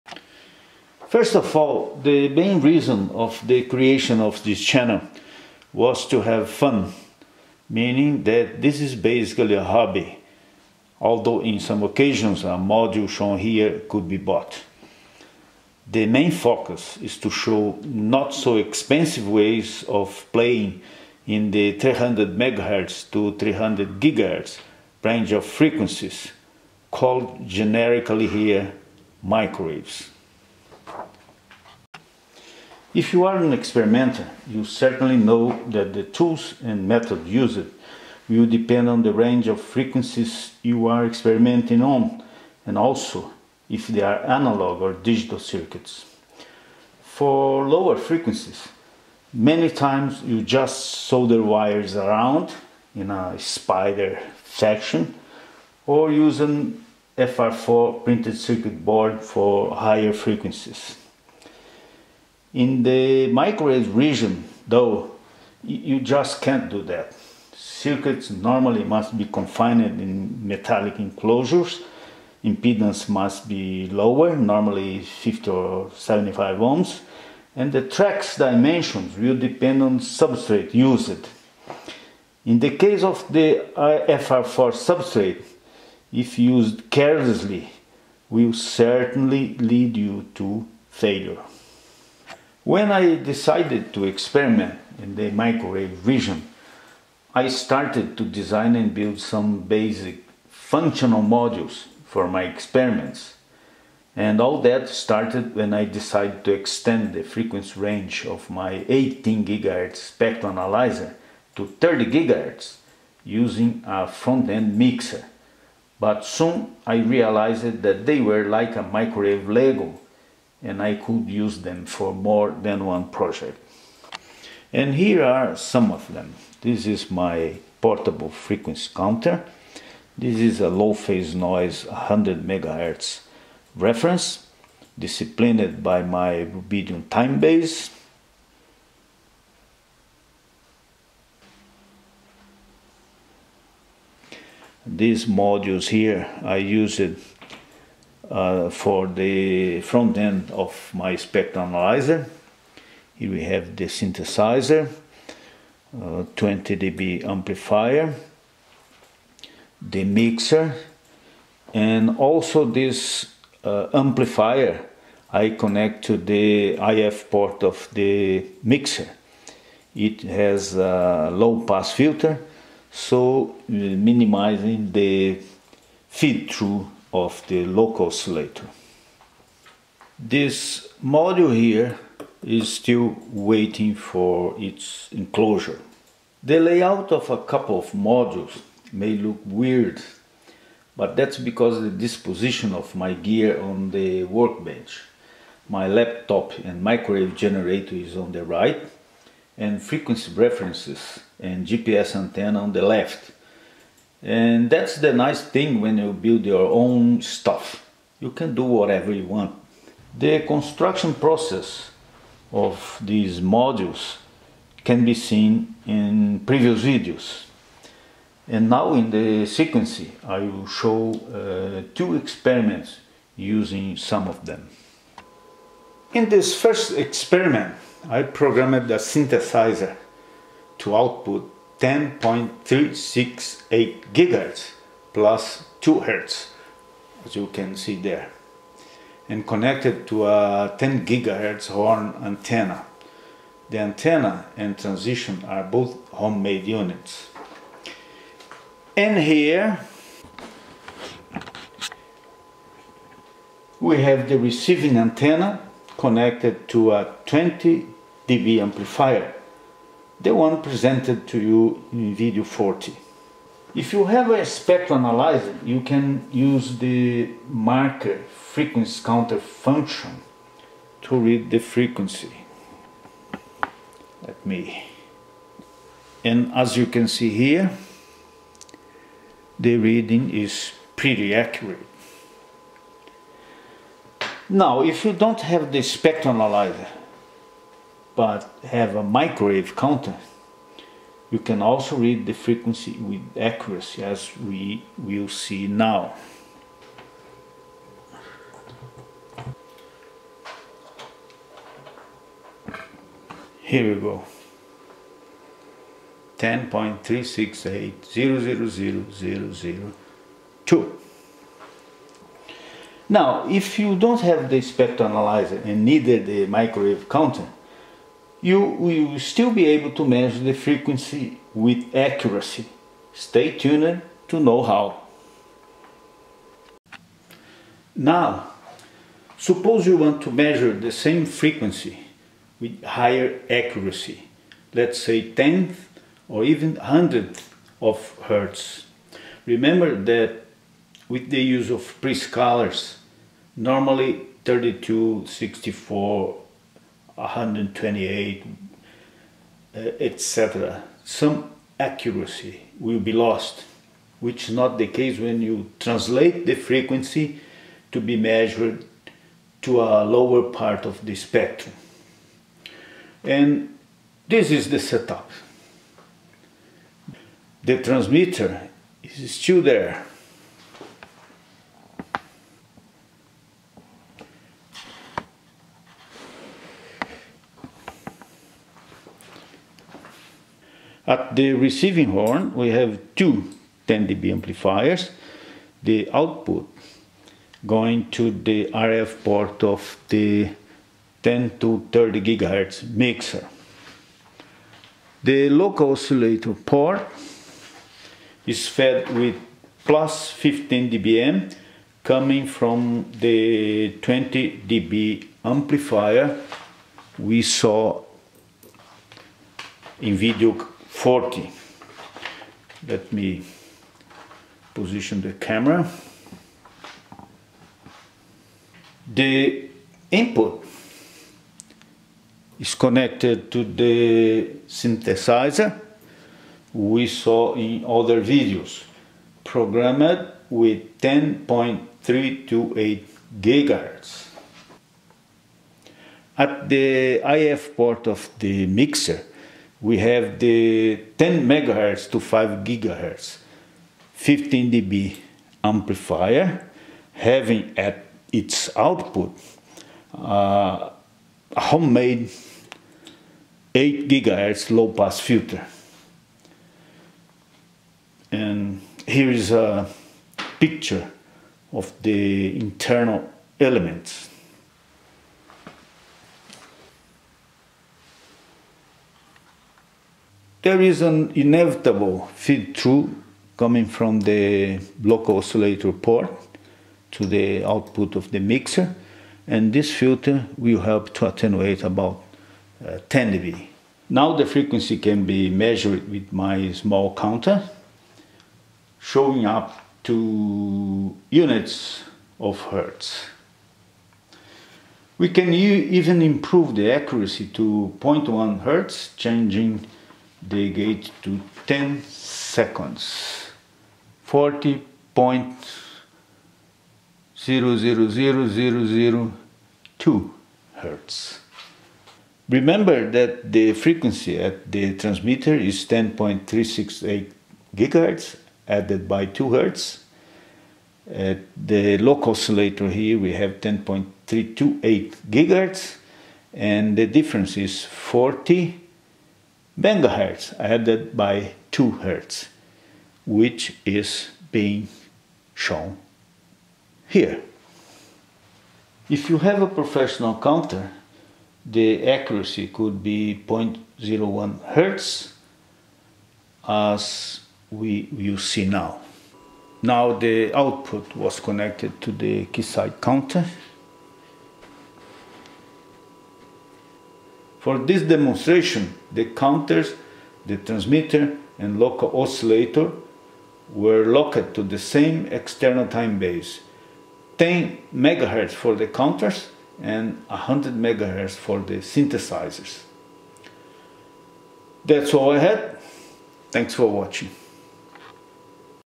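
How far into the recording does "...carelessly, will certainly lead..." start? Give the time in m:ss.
1:26.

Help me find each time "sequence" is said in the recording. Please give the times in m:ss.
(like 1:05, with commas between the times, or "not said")
3:39.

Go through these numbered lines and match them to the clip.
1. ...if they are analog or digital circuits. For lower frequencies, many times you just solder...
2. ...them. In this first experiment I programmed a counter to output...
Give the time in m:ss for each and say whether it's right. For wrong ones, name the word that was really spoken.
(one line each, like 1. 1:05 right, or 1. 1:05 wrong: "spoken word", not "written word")
1. 0:43 right
2. 3:44 wrong: "synthesizer", not "counter".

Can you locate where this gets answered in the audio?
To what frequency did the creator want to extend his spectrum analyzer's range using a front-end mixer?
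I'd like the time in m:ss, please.
1:51.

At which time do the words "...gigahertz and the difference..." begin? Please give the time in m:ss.
8:45.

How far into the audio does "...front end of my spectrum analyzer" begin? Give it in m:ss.
2:29.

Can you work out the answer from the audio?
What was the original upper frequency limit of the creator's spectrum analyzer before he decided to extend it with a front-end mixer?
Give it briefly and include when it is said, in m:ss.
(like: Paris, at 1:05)
18 GHz, at 1:48.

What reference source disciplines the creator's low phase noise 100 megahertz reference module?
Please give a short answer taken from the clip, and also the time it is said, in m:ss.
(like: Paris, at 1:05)
rubidium time base, at 2:16.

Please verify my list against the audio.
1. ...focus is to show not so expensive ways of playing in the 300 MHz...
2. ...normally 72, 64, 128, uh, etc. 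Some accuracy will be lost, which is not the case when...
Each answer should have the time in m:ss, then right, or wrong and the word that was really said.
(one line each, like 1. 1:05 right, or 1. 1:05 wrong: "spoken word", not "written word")
1. 0:16 right
2. 5:43 wrong: "32", not "72".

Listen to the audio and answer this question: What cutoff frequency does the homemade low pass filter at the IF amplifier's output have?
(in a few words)
8 GHz.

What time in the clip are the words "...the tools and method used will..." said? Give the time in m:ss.
0:35.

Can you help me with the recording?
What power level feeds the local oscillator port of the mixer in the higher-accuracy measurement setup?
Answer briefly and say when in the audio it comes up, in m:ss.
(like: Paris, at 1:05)
+15 dBm, at 6:39.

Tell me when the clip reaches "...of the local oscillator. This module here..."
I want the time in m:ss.
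2:57.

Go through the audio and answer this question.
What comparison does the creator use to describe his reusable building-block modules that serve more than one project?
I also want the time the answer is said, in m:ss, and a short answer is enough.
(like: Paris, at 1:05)
microwave Lego, at 1:58.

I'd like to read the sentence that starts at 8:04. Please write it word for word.
Now the frequency can be measured with my small counter showing up to units of hertz.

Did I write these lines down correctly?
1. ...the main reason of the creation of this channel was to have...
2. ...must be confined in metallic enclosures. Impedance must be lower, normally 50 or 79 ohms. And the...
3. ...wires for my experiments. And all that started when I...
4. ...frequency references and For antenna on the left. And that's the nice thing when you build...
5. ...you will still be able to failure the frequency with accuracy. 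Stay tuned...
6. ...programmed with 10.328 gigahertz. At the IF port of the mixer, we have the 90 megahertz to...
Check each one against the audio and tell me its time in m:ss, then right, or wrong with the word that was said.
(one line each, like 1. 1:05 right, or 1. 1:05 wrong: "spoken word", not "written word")
1. 0:02 right
2. 1:08 wrong: "75", not "79"
3. 1:41 wrong: "modules", not "wires"
4. 3:19 wrong: "GPS", not "For"
5. 5:18 wrong: "measure", not "failure"
6. 7:09 wrong: "10", not "90".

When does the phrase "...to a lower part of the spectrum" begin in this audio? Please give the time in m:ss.
5:59.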